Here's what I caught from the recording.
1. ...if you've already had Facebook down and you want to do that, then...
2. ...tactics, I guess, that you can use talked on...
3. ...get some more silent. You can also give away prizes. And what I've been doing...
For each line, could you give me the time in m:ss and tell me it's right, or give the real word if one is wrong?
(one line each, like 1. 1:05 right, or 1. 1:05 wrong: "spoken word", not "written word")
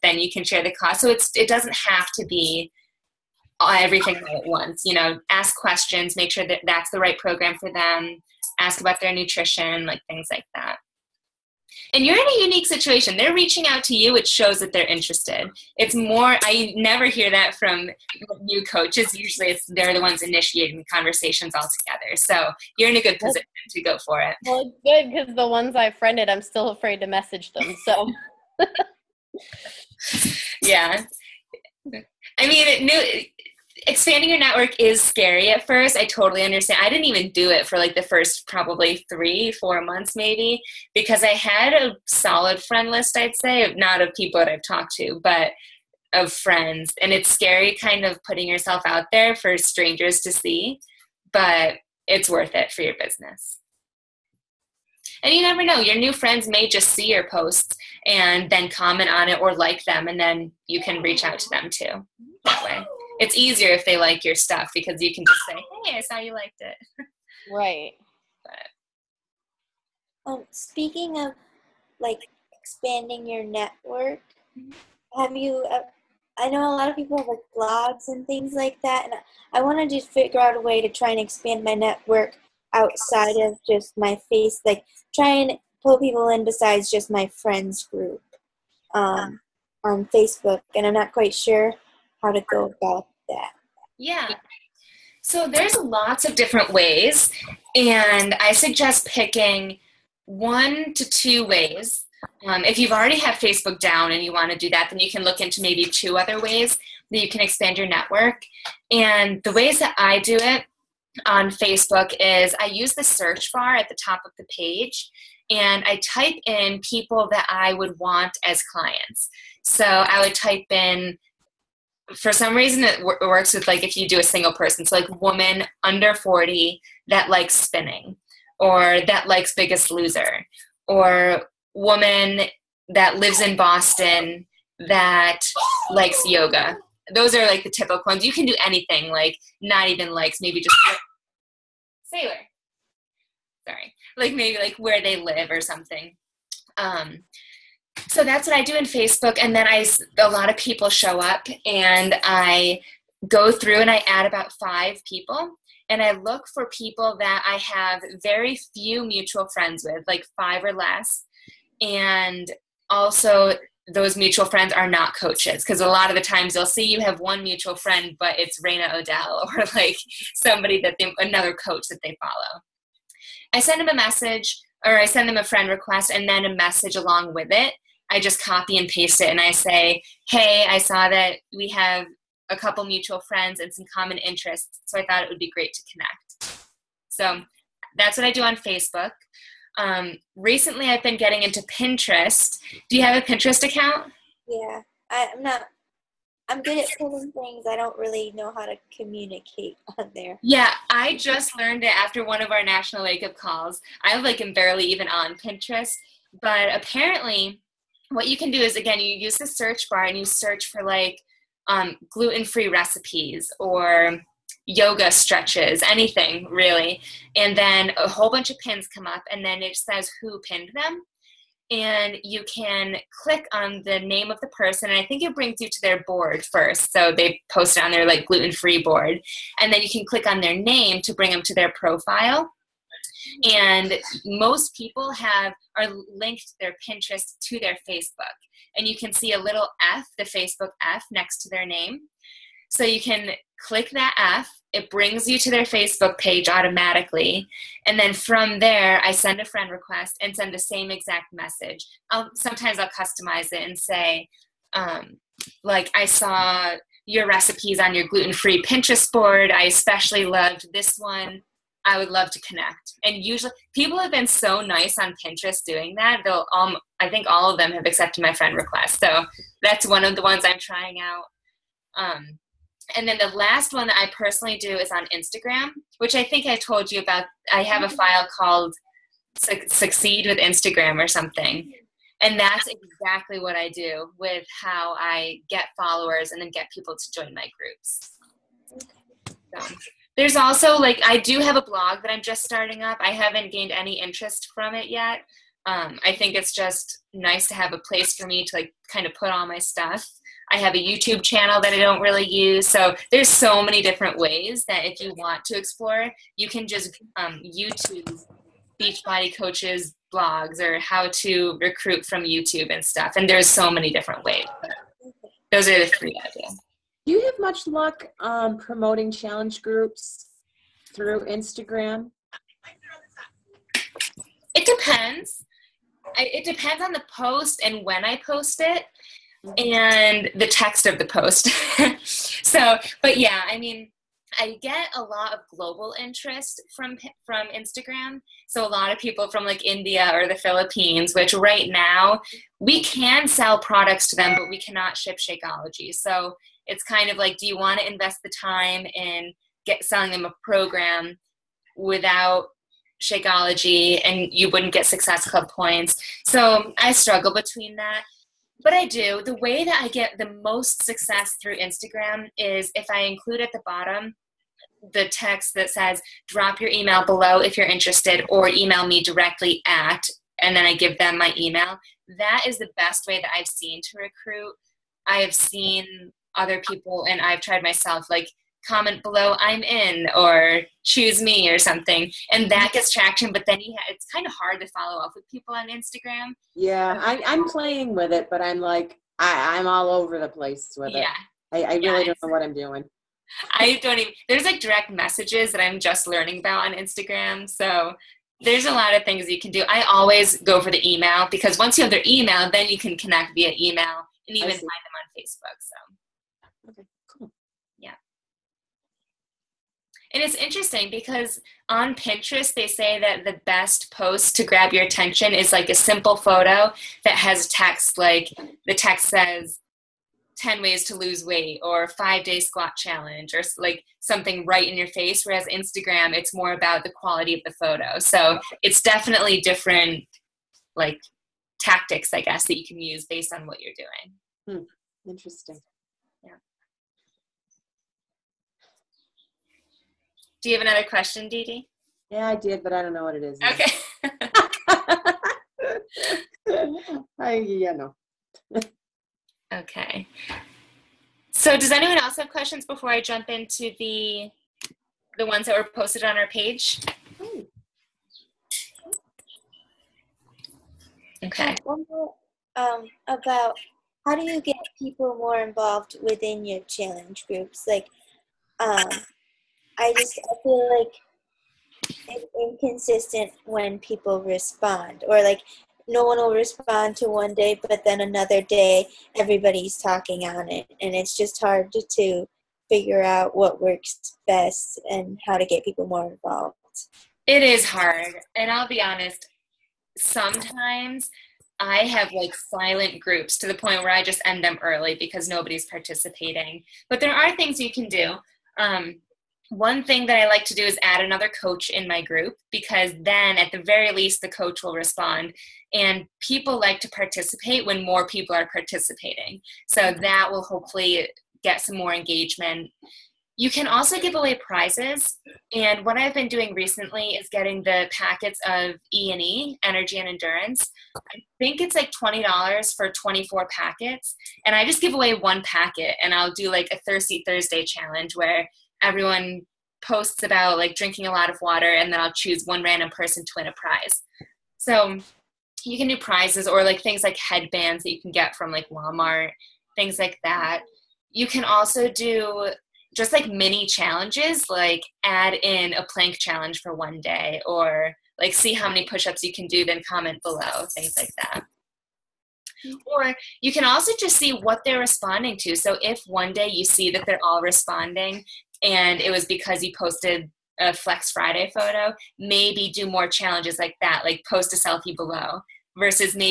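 1. 1:42 right
2. 7:11 wrong: "based", not "talked"
3. 8:31 wrong: "engagement", not "silent".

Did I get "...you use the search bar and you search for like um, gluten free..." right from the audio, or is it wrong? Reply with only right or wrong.
right.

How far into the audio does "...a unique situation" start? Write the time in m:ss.
0:12.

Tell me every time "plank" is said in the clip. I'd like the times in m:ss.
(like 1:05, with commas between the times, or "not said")
9:05.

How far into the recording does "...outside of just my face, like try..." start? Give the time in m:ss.
1:22.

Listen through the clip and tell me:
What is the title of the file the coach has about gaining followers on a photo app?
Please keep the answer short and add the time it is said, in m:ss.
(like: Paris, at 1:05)
Succeed with Instagram, at 4:39.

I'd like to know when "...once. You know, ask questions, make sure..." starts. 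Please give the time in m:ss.
0:04.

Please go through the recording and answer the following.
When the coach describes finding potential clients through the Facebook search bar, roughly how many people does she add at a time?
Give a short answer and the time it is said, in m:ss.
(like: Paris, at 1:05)
5, at 2:34.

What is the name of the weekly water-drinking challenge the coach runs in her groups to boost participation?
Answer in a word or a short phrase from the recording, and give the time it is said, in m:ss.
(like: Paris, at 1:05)
Thirsty Thursday, at 8:46.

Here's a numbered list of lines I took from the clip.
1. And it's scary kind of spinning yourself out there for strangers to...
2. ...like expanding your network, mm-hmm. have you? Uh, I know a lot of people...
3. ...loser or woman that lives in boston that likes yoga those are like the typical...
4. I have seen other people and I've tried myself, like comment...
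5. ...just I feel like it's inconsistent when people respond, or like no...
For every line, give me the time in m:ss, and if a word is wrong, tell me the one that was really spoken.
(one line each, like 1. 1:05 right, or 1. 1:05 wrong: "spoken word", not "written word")
1. 0:47 wrong: "putting", not "spinning"
2. 1:11 right
3. 2:09 right
4. 6:15 right
5. 7:49 right.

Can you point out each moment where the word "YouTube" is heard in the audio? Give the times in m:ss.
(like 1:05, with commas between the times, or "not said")
5:00, 5:07, 5:12.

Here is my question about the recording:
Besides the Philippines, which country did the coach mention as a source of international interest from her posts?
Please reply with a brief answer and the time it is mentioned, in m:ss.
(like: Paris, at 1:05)
India, at 5:39.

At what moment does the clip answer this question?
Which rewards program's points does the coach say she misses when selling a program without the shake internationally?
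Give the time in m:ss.
5:54.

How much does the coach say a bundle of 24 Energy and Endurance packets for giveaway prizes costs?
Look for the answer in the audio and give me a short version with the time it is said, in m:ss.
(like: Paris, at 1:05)
$20, at 8:41.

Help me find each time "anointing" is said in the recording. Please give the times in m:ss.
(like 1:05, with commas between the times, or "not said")
not said.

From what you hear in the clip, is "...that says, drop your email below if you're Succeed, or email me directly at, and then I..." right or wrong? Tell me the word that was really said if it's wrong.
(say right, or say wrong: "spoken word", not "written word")
wrong: "interested", not "Succeed".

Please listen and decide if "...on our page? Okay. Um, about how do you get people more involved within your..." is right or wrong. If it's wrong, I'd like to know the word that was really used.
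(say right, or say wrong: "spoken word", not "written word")
right.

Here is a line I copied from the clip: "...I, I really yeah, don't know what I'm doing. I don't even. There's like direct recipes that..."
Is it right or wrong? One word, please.
wrong.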